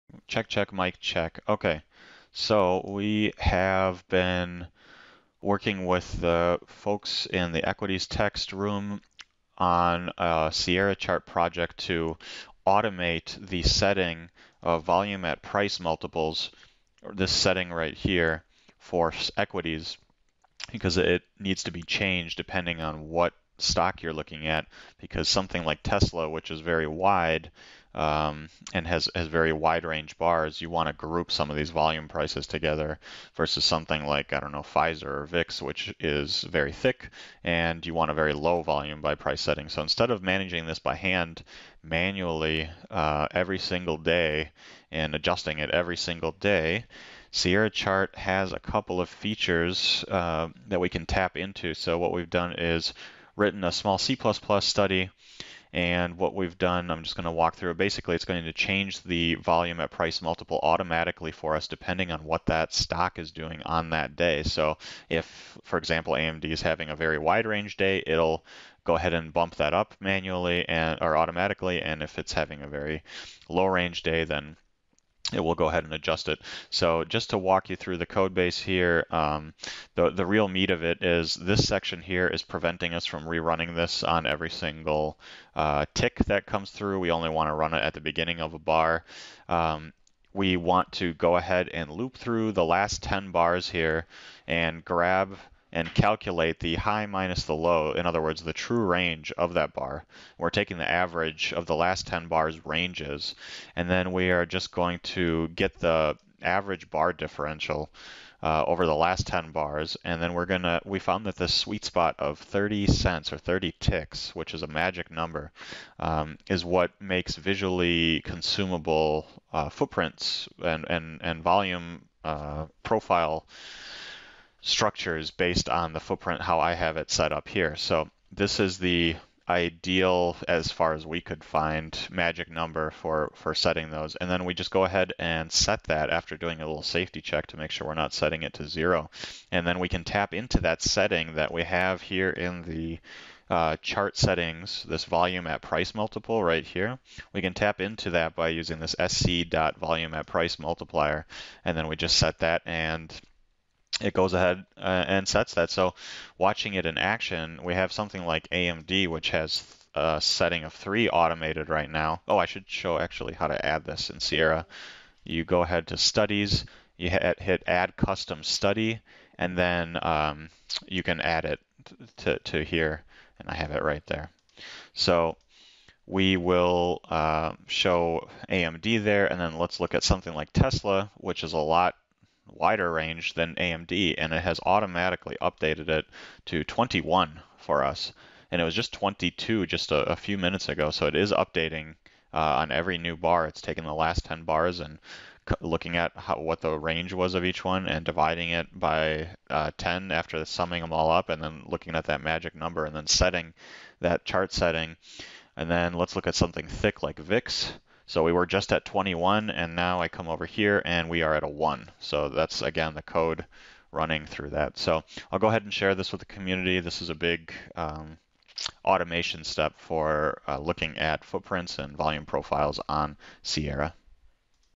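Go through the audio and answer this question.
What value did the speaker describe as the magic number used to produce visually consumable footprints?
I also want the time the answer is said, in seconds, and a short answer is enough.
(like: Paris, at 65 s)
30 ticks, at 113 s.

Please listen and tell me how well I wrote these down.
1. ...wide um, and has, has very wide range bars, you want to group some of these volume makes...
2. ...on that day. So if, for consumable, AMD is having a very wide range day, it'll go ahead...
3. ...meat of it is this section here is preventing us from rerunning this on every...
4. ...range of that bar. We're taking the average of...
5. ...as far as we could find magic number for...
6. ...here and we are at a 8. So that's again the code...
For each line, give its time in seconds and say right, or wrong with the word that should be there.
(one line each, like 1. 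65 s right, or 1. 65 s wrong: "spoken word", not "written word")
1. 26 s wrong: "prices", not "makes"
2. 63 s wrong: "example", not "consumable"
3. 80 s right
4. 98 s right
5. 130 s right
6. 210 s wrong: "1", not "8".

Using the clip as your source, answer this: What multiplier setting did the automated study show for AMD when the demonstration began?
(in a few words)
3.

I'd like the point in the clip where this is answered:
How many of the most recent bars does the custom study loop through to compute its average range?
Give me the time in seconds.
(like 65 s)
92 s.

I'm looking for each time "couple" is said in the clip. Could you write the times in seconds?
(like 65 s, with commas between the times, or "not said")
48 s.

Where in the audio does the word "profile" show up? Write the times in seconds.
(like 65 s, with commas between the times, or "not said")
122 s, 222 s.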